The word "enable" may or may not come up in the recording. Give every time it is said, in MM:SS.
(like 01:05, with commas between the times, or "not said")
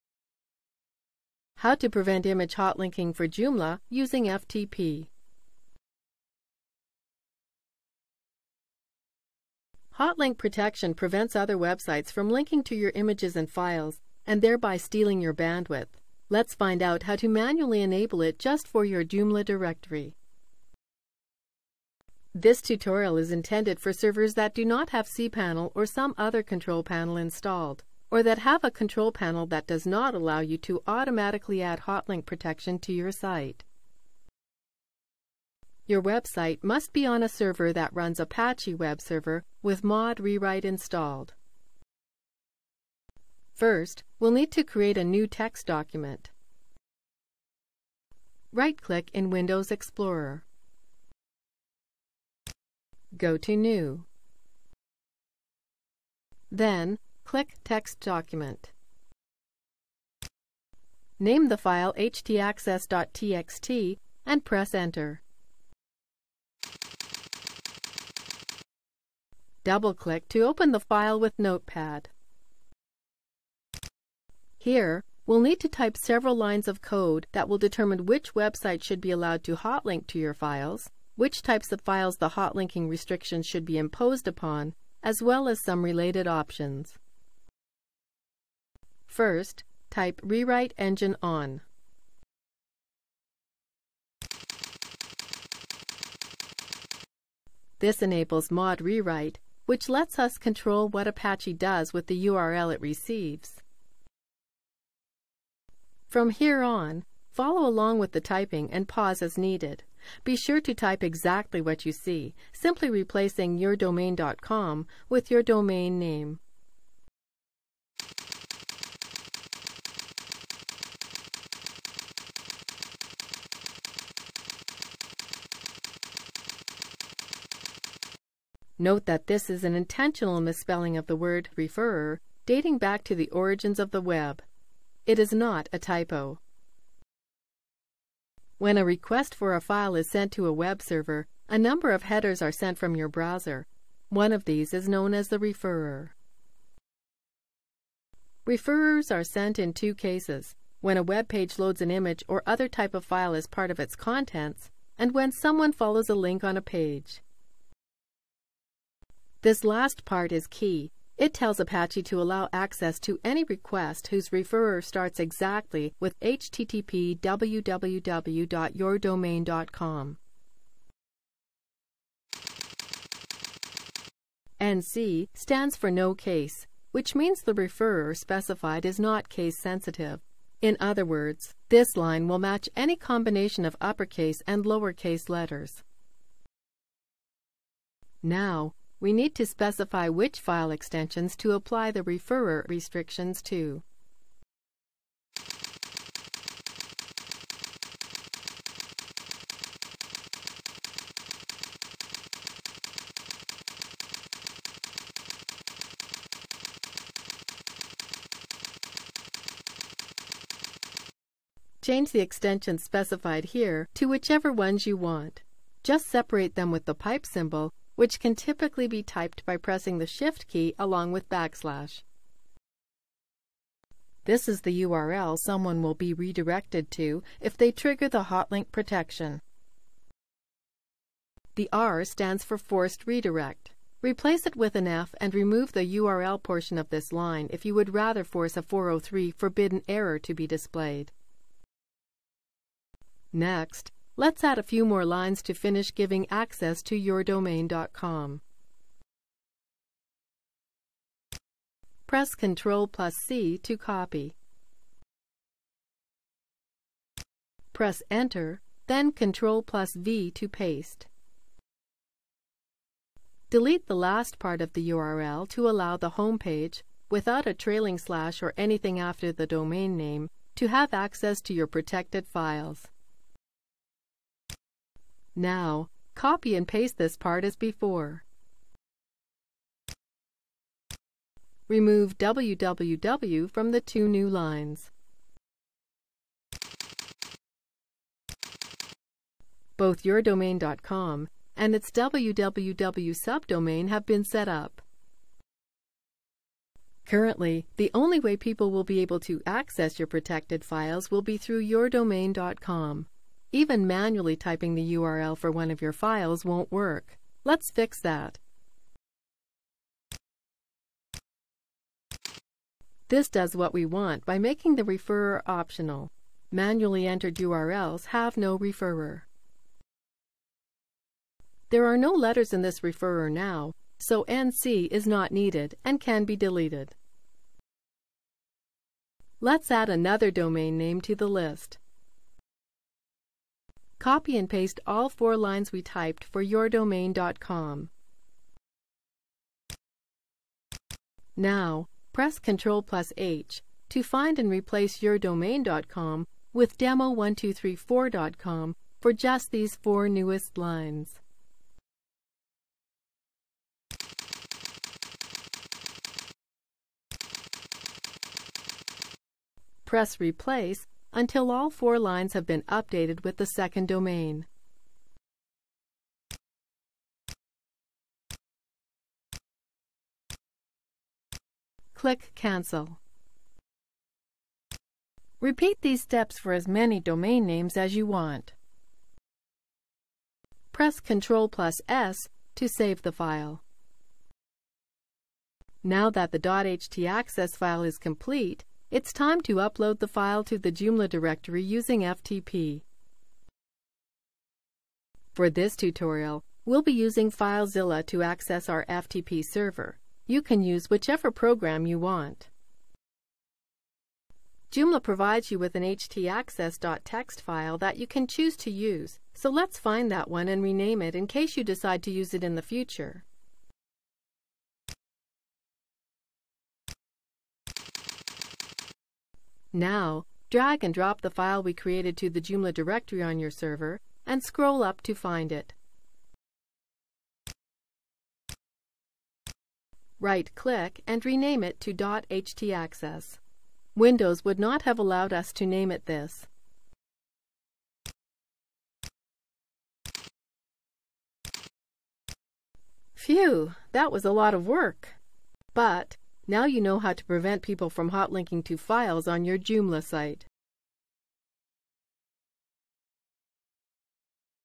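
00:17, 01:38.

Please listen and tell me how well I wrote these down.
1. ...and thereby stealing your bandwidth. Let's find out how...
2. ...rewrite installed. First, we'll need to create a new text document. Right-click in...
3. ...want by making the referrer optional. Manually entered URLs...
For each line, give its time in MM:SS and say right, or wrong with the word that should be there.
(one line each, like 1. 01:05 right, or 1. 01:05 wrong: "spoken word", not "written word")
1. 00:14 right
2. 00:40 right
3. 05:13 right.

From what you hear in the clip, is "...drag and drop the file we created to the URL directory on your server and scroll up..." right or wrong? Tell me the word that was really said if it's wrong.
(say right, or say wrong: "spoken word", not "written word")
wrong: "Joomla", not "URL".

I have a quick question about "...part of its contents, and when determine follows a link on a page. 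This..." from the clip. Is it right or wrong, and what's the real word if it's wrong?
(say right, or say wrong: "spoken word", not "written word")
wrong: "someone", not "determine".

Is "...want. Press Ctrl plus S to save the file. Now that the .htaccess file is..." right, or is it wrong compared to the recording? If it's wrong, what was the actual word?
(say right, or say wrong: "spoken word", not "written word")
right.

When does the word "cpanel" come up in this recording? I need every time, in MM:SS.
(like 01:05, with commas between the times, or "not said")
00:25.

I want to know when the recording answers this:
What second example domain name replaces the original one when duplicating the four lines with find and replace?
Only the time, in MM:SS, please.
05:46.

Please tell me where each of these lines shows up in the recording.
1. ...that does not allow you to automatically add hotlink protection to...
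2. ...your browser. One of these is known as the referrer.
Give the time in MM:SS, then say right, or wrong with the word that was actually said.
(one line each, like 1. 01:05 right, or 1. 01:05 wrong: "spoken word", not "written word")
1. 00:29 right
2. 02:22 right.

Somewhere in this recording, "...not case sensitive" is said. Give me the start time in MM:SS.
02:58.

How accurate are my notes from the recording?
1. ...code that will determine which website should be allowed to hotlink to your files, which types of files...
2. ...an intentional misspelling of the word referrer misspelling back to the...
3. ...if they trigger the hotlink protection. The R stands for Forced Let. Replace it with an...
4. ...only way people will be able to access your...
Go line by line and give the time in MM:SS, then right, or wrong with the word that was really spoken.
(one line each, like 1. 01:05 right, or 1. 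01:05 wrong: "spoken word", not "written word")
1. 01:16 right
2. 02:09 wrong: "dating", not "misspelling"
3. 03:47 wrong: "Redirect", not "Let"
4. 04:57 right.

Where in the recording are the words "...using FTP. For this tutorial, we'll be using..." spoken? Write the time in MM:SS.
06:31.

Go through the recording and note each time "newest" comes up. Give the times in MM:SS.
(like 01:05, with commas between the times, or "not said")
05:50.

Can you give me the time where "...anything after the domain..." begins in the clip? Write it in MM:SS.
04:28.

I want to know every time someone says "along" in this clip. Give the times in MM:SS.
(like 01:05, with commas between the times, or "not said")
01:47, 03:40.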